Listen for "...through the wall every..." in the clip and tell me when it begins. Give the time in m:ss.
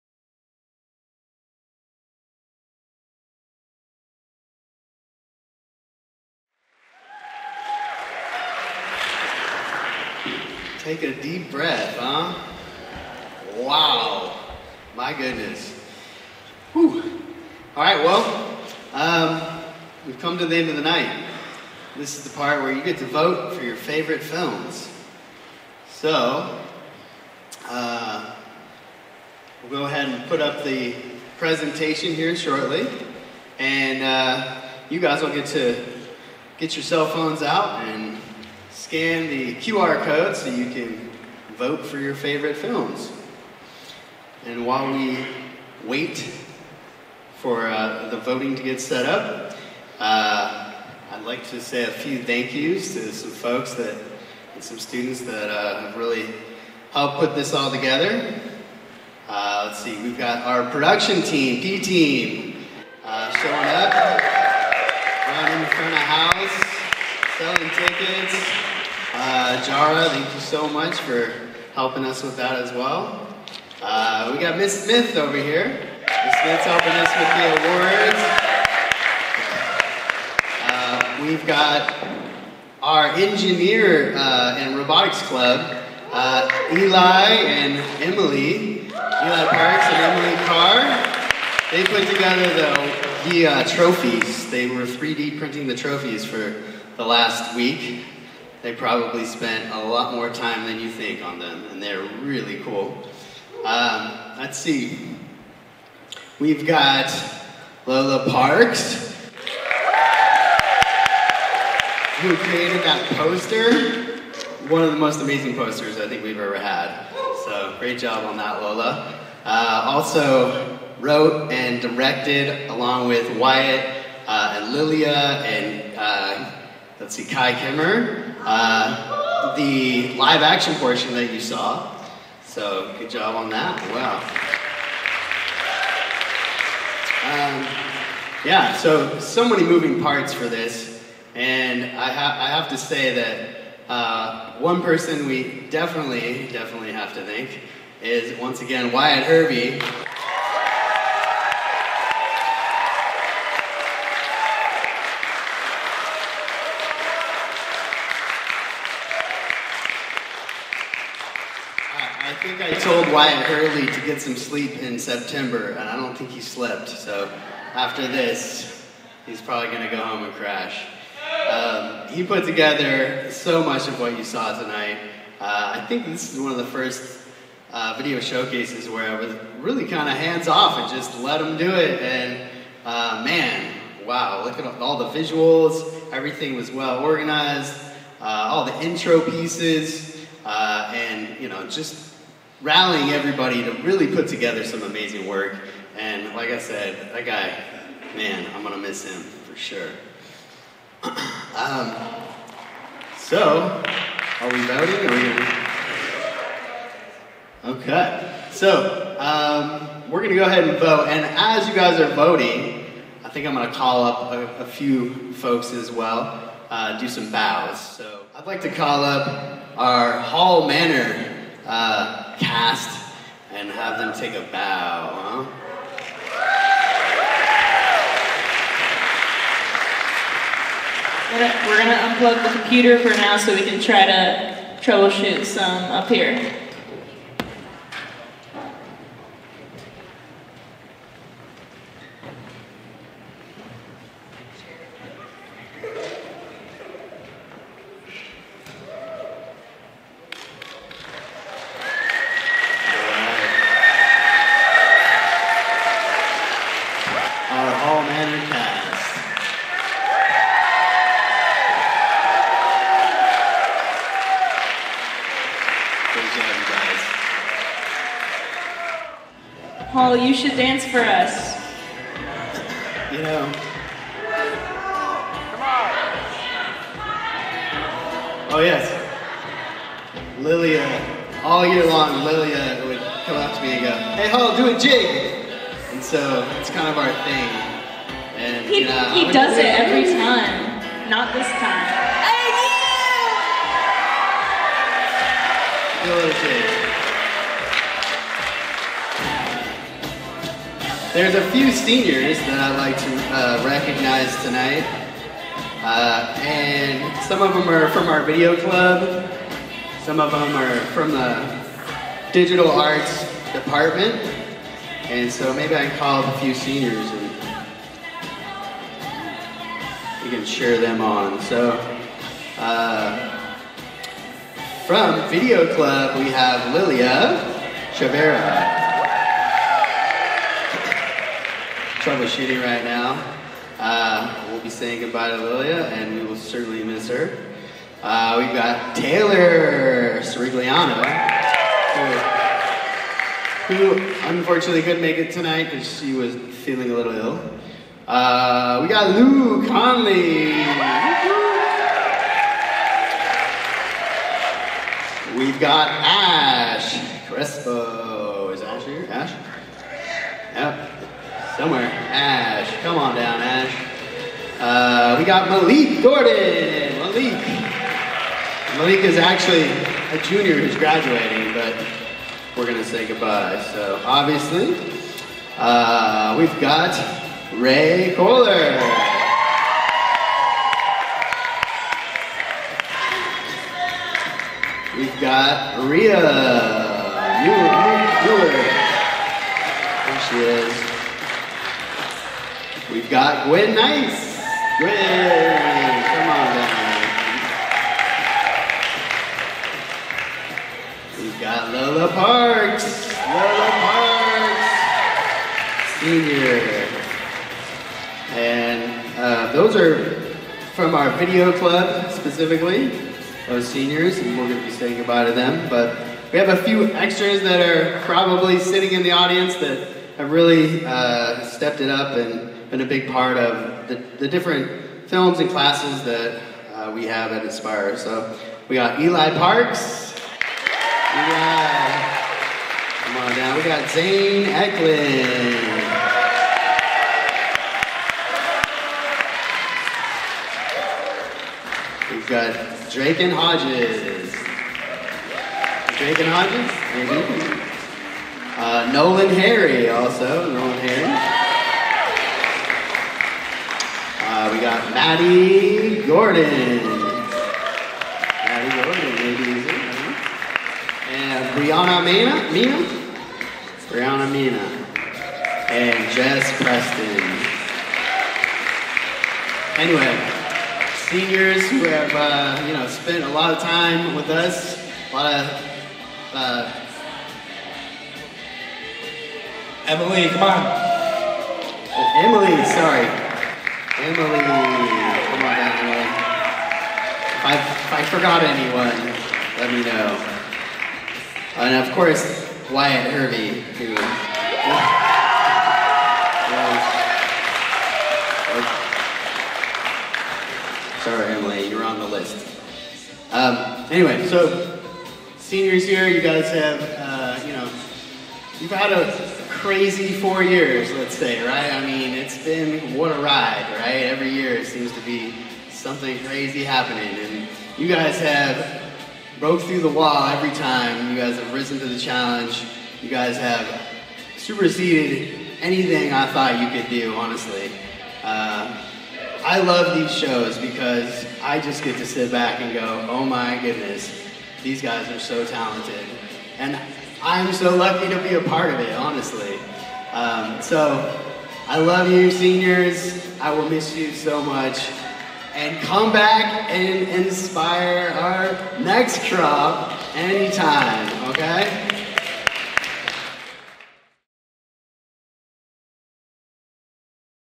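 8:39.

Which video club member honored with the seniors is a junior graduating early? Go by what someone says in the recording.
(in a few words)
Malik Gordon.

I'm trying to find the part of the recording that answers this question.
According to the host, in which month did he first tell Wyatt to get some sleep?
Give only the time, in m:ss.
2:44.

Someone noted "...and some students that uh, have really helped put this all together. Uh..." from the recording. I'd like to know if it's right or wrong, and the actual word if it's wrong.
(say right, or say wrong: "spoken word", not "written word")
right.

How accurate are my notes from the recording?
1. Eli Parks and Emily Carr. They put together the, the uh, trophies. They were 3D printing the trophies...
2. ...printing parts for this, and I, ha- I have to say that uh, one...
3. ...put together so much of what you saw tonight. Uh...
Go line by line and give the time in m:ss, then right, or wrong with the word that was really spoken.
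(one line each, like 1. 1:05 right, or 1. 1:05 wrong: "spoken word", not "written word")
1. 1:28 right
2. 2:19 wrong: "moving", not "printing"
3. 2:52 right.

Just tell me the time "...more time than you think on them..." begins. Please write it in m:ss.
1:40.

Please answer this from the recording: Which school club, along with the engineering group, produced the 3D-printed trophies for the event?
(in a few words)
Robotics club.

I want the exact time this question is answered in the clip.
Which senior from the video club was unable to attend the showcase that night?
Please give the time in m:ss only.
5:38.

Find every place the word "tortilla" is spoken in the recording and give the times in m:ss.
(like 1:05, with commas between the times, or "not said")
not said.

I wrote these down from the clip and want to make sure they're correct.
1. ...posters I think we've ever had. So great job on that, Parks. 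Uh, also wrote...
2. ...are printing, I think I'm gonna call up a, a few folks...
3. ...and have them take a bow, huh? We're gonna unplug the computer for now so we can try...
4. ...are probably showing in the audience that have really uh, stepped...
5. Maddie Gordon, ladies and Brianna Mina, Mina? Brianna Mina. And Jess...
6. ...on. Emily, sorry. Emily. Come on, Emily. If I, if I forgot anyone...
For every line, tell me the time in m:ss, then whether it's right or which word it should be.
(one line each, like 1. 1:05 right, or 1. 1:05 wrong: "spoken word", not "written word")
1. 1:55 wrong: "Lola", not "Parks"
2. 3:31 wrong: "voting", not "printing"
3. 3:43 right
4. 6:57 wrong: "sitting", not "showing"
5. 7:38 right
6. 8:00 right.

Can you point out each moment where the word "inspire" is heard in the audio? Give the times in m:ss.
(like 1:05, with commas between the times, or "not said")
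7:07, 9:07.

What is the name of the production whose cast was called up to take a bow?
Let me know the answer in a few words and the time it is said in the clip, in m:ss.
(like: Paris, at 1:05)
Hall Manor, at 3:40.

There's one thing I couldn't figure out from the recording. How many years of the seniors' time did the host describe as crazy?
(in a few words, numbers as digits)
4.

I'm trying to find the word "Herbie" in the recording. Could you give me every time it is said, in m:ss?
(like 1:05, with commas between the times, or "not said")
2:29.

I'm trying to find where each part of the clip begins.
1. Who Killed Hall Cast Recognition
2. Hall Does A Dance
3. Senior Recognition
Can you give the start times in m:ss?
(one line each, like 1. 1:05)
1. 3:37
2. 4:29
3. 5:00.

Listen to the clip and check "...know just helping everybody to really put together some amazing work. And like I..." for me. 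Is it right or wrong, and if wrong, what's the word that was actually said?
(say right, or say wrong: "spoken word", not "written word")
wrong: "rallying", not "helping".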